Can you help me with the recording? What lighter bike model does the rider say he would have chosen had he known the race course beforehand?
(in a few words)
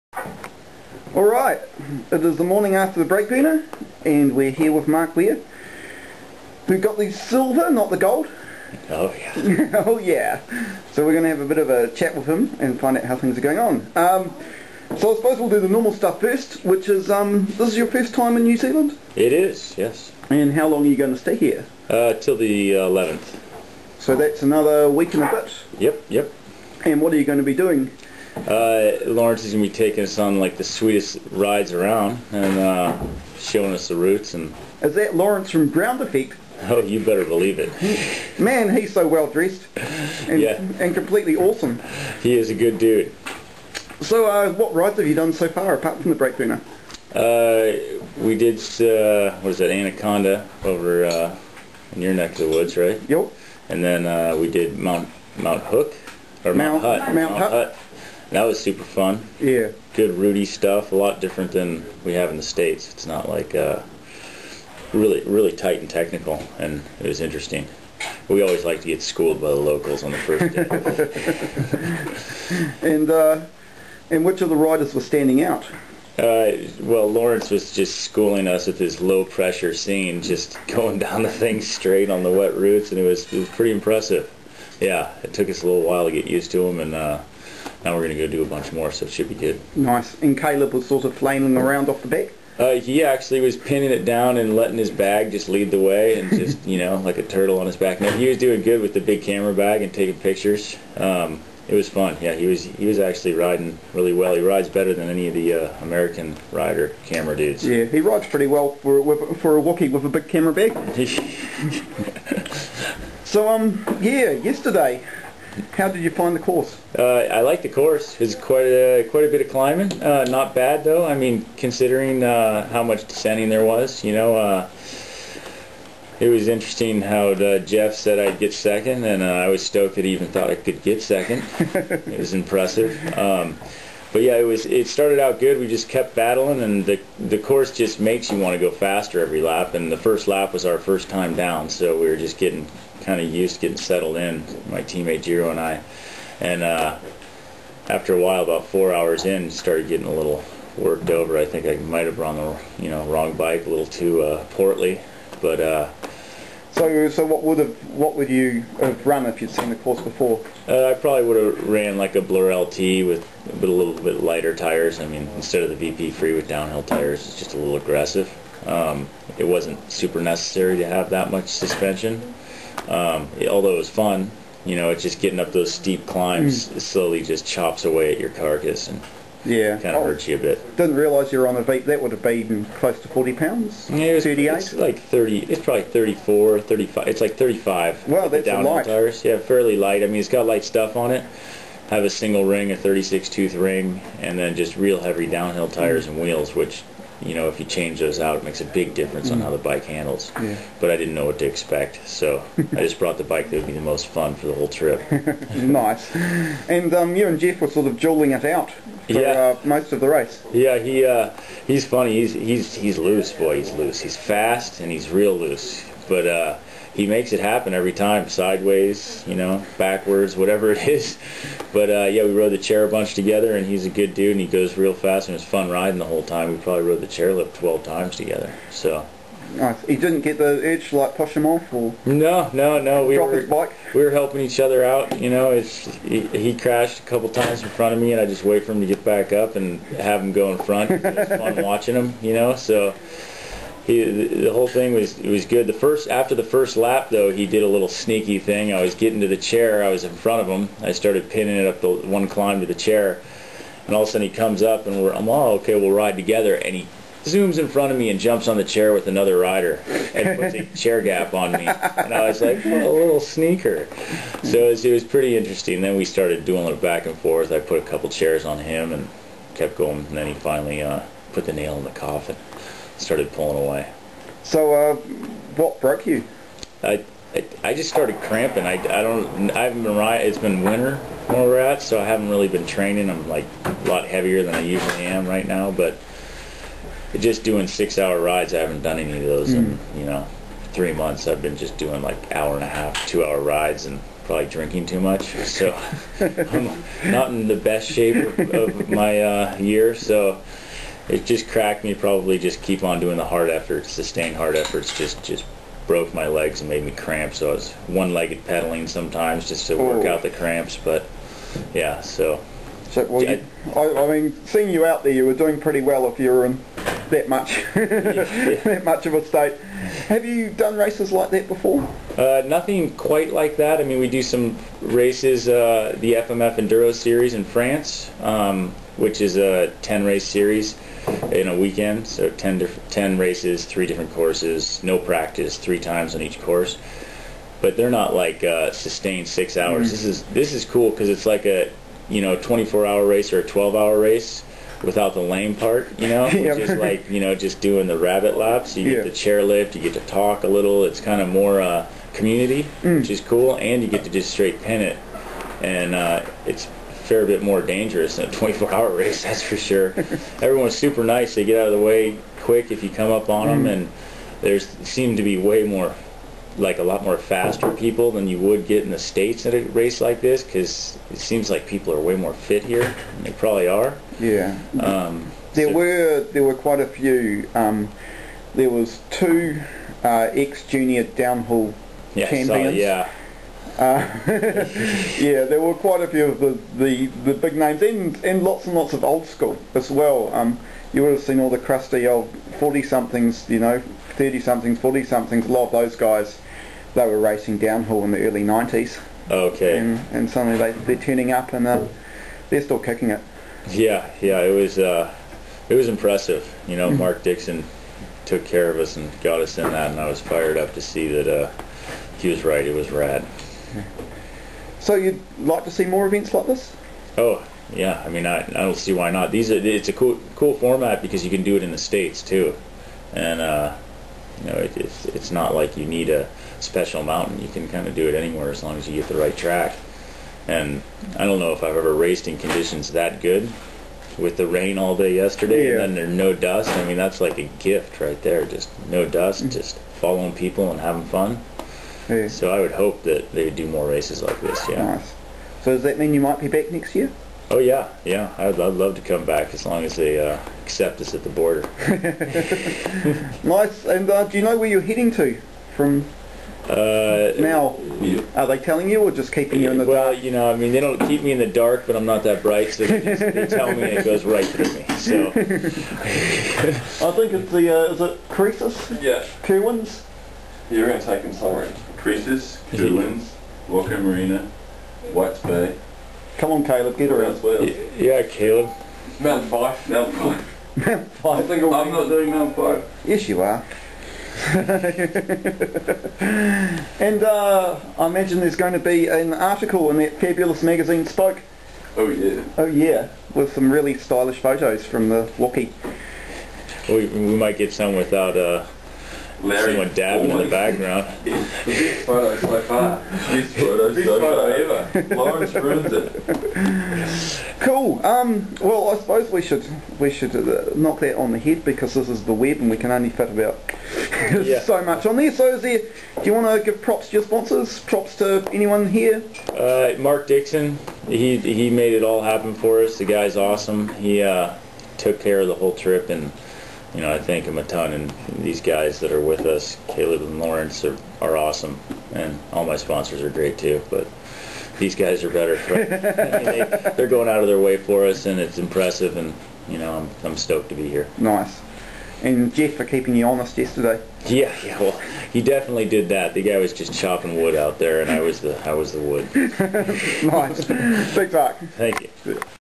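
Blur LT.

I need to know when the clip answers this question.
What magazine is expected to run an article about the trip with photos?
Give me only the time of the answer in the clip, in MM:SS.
08:11.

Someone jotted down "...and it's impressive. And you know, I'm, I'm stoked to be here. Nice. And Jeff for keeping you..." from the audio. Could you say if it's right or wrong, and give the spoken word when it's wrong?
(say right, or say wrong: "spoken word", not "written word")
right.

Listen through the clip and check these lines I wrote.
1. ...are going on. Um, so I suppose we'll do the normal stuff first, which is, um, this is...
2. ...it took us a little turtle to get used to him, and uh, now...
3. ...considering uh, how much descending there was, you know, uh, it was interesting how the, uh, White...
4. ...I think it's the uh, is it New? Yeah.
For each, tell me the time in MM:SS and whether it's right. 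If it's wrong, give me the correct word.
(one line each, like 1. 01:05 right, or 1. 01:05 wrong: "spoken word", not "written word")
1. 00:13 right
2. 01:25 wrong: "while", not "turtle"
3. 02:01 wrong: "Jeff", not "White"
4. 07:45 wrong: "Croesus", not "New".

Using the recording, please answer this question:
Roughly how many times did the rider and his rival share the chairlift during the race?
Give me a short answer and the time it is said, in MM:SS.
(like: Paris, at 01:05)
12, at 03:47.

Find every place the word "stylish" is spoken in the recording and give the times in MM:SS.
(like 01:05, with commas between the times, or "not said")
08:13.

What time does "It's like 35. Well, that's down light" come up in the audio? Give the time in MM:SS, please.
03:07.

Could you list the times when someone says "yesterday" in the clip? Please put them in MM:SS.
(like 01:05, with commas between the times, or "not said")
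01:54, 07:15, 09:03.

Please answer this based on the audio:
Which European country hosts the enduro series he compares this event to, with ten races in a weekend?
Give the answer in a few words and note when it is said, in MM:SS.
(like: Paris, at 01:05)
France, at 05:27.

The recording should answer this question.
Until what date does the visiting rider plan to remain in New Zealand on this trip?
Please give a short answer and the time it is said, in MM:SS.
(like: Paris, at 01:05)
the 11th, at 00:22.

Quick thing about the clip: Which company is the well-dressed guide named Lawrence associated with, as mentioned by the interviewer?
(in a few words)
Ground Effect.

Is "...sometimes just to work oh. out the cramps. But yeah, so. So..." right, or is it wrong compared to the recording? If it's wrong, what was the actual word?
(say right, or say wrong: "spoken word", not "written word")
right.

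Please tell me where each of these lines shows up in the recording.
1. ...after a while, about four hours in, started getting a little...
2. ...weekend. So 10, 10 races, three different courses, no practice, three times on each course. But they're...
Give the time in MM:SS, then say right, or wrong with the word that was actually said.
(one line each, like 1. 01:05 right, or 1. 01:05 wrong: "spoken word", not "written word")
1. 02:27 right
2. 05:31 right.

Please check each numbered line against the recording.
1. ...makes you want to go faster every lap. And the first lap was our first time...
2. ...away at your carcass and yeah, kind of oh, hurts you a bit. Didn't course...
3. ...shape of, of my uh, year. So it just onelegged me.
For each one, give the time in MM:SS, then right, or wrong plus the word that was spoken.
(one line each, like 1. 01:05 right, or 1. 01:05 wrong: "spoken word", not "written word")
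1. 02:17 right
2. 02:57 wrong: "realise", not "course"
3. 04:57 wrong: "cracked", not "onelegged".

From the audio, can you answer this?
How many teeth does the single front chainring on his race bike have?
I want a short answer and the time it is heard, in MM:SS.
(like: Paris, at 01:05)
36, at 03:12.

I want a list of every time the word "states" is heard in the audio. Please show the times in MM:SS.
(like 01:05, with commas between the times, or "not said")
01:02, 05:19, 06:08, 07:01.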